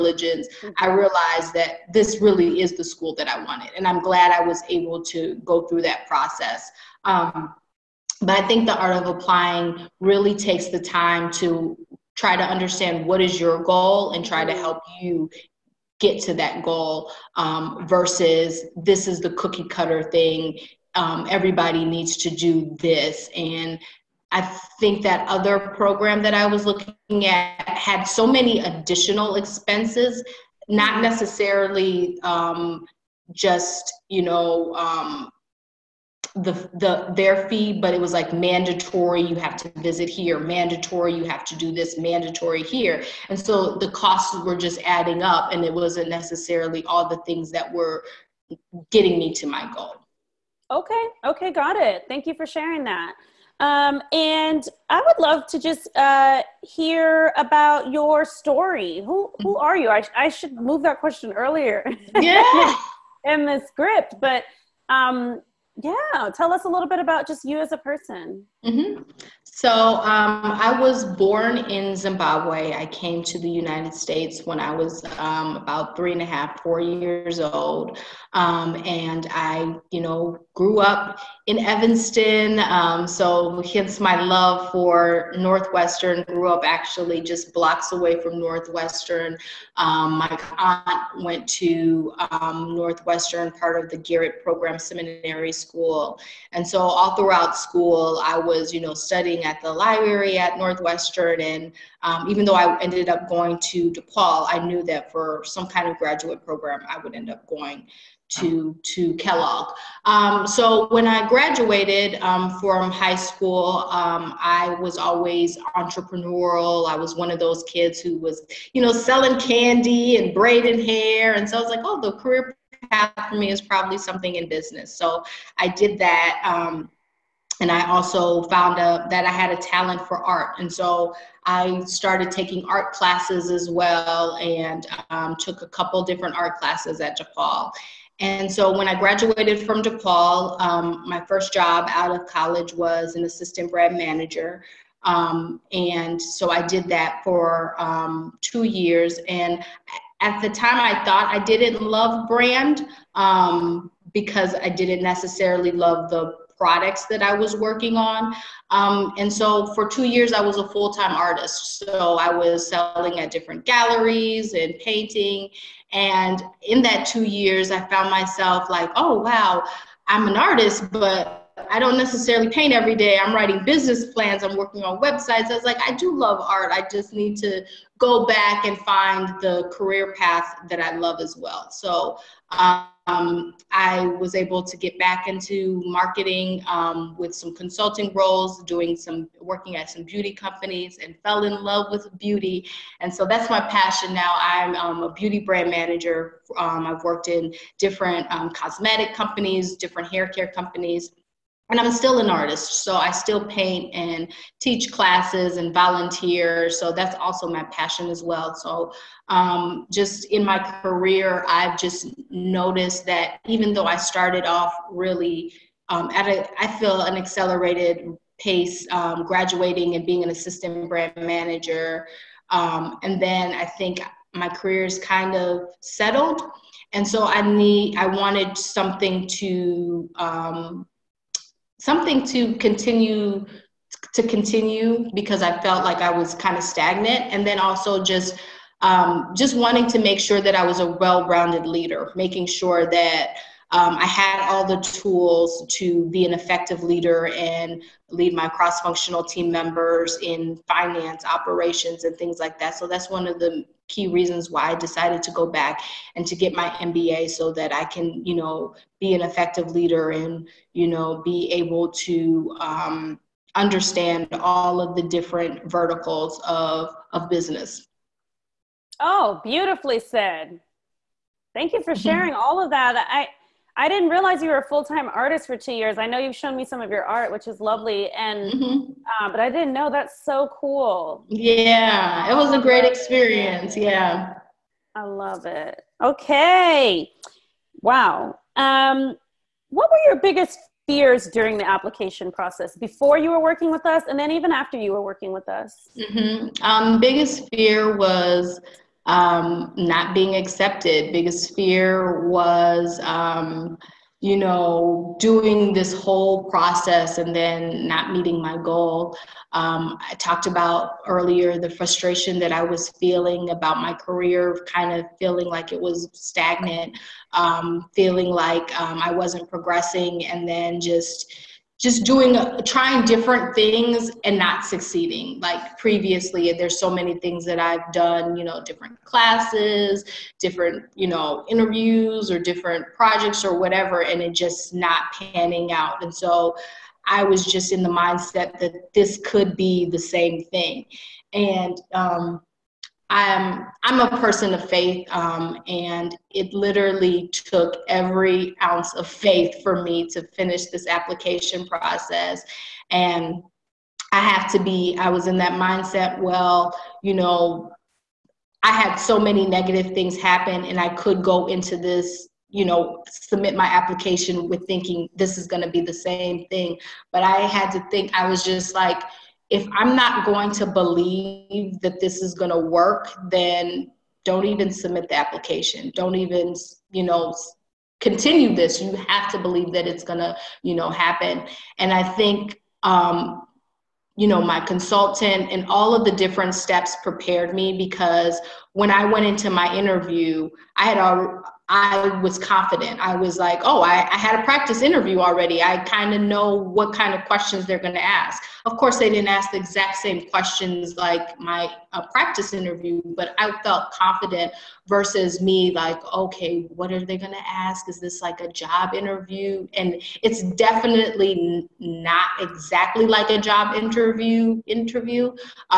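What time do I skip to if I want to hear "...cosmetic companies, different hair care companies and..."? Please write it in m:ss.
3:18.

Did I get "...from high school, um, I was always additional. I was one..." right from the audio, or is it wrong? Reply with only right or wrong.
wrong.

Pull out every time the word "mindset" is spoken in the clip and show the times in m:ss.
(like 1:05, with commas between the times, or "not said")
5:37, 5:55.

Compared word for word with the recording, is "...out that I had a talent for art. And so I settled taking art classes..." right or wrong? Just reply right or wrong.
wrong.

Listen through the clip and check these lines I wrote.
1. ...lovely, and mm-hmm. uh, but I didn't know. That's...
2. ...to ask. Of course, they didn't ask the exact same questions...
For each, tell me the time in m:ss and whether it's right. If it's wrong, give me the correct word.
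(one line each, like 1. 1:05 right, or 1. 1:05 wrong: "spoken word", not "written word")
1. 4:37 right
2. 6:37 right.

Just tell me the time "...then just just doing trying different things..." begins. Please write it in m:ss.
5:20.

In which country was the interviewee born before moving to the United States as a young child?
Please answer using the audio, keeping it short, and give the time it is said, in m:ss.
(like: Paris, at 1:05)
Zimbabwe, at 1:11.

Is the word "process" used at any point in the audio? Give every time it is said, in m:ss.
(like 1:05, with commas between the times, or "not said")
0:06, 4:52, 5:06, 5:51.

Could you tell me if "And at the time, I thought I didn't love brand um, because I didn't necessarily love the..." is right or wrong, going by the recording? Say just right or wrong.
right.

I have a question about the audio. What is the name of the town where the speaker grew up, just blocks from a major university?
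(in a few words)
Evanston.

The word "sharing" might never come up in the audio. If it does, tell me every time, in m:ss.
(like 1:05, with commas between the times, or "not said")
0:52, 4:31.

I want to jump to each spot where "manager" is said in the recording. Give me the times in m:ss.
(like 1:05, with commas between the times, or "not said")
2:23, 3:15, 3:41.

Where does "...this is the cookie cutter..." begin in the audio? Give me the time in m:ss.
0:18.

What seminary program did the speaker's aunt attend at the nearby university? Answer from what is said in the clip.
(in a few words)
Garrett Program.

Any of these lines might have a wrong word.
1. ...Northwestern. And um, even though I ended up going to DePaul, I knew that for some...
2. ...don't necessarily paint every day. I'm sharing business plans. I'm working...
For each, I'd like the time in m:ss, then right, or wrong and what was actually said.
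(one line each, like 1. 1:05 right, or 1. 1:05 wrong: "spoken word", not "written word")
1. 1:40 right
2. 2:51 wrong: "writing", not "sharing".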